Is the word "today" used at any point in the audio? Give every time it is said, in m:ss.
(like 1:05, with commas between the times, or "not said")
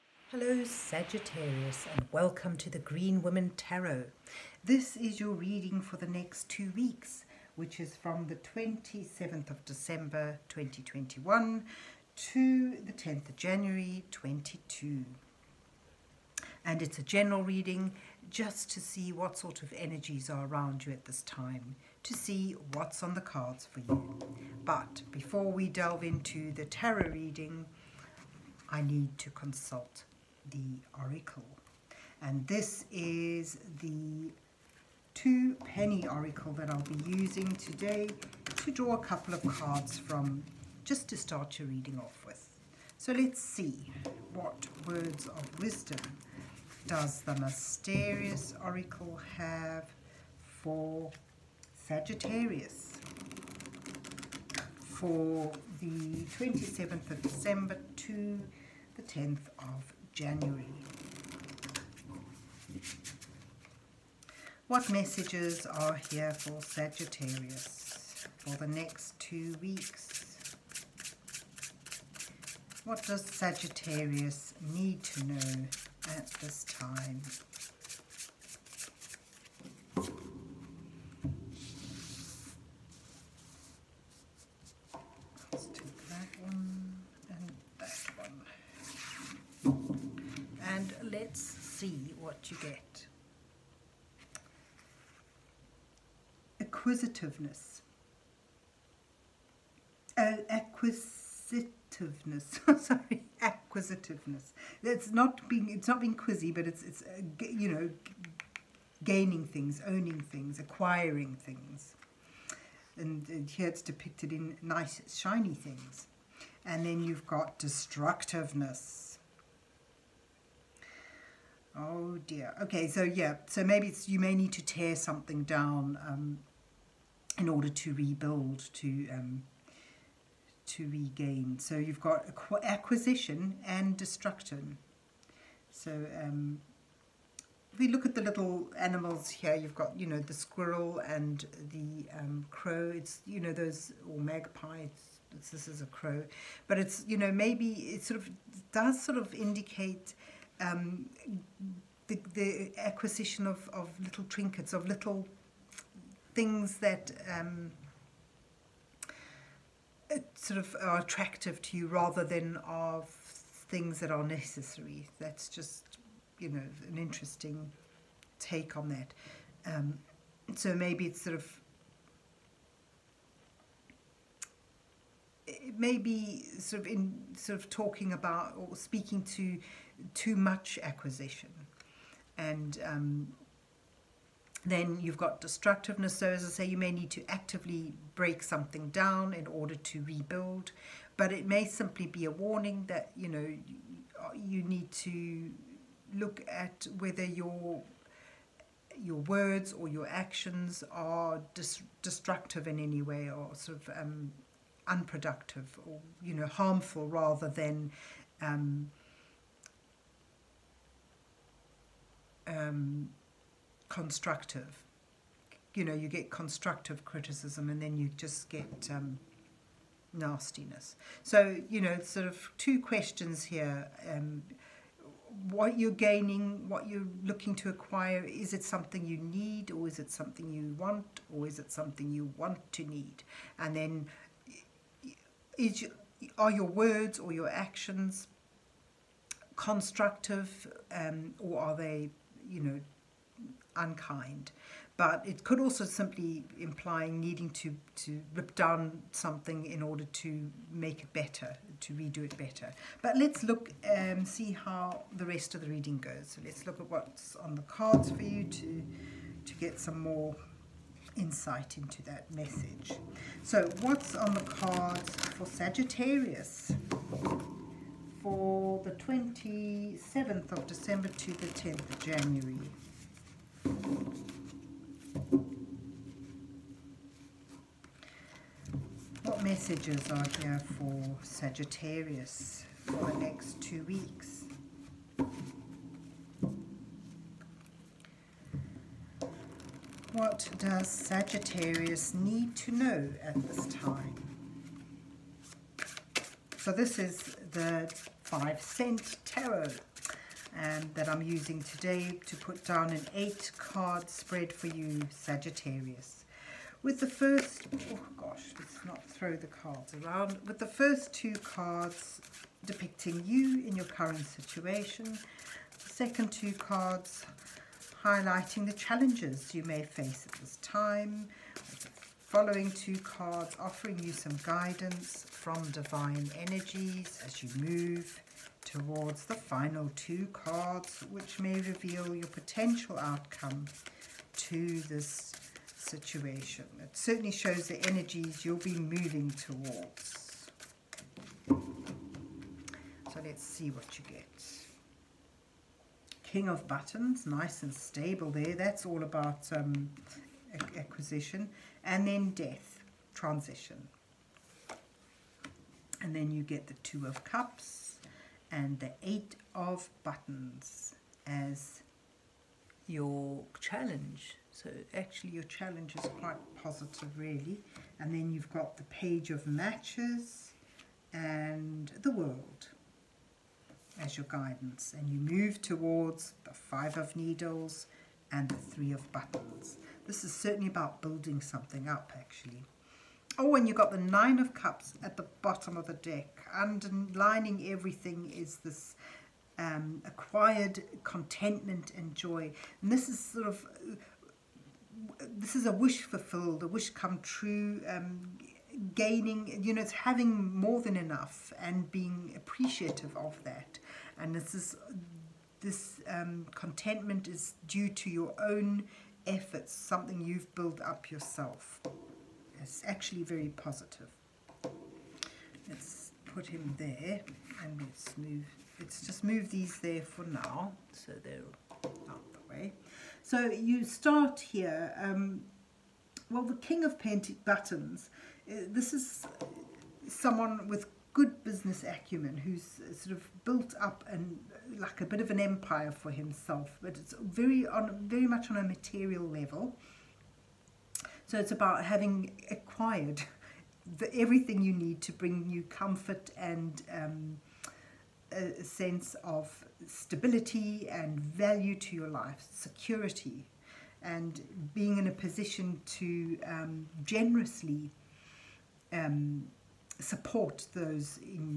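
0:37, 5:01.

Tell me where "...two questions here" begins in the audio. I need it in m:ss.
3:42.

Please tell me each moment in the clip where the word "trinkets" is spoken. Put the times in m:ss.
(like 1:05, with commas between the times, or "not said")
2:34.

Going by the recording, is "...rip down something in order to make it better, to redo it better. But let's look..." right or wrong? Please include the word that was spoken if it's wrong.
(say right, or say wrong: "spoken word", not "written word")
right.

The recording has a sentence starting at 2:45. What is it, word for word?
That's just, you know, an interesting take on that.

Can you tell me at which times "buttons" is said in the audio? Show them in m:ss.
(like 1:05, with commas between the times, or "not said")
5:46, 6:00, 6:19, 7:07.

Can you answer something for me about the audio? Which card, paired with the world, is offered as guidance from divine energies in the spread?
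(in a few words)
page of matches.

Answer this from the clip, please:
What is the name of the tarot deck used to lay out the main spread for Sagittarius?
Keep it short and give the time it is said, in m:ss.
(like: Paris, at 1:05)
five cent tarot, at 4:58.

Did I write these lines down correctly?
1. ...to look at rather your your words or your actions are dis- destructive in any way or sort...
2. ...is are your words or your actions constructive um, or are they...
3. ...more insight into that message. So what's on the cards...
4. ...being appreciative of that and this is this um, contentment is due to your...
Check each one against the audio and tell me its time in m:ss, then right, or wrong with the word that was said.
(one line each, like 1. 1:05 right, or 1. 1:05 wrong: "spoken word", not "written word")
1. 3:14 wrong: "whether", not "rather"
2. 3:55 right
3. 4:20 right
4. 6:41 right.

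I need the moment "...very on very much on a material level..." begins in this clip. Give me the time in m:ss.
7:17.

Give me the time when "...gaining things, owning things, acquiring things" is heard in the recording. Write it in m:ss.
1:49.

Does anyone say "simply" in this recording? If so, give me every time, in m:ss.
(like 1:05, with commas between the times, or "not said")
3:11, 4:05.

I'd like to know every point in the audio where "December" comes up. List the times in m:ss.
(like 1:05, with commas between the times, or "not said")
0:09, 0:57, 4:30.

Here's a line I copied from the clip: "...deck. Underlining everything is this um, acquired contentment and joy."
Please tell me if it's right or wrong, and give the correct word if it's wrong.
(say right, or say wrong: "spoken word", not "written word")
right.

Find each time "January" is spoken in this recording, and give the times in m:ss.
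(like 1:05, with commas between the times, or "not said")
0:13, 1:00, 4:32.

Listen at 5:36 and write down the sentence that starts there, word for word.
It certainly shows the energies you'll be moving towards.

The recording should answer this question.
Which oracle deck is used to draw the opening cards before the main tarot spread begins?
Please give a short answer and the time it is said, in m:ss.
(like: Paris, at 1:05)
two penny Oracle, at 0:35.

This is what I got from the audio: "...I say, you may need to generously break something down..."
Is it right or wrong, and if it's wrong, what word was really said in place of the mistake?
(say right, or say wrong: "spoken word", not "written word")
wrong: "actively", not "generously".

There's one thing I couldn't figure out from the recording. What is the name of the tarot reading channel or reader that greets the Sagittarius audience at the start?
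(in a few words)
Green Woman Tarot.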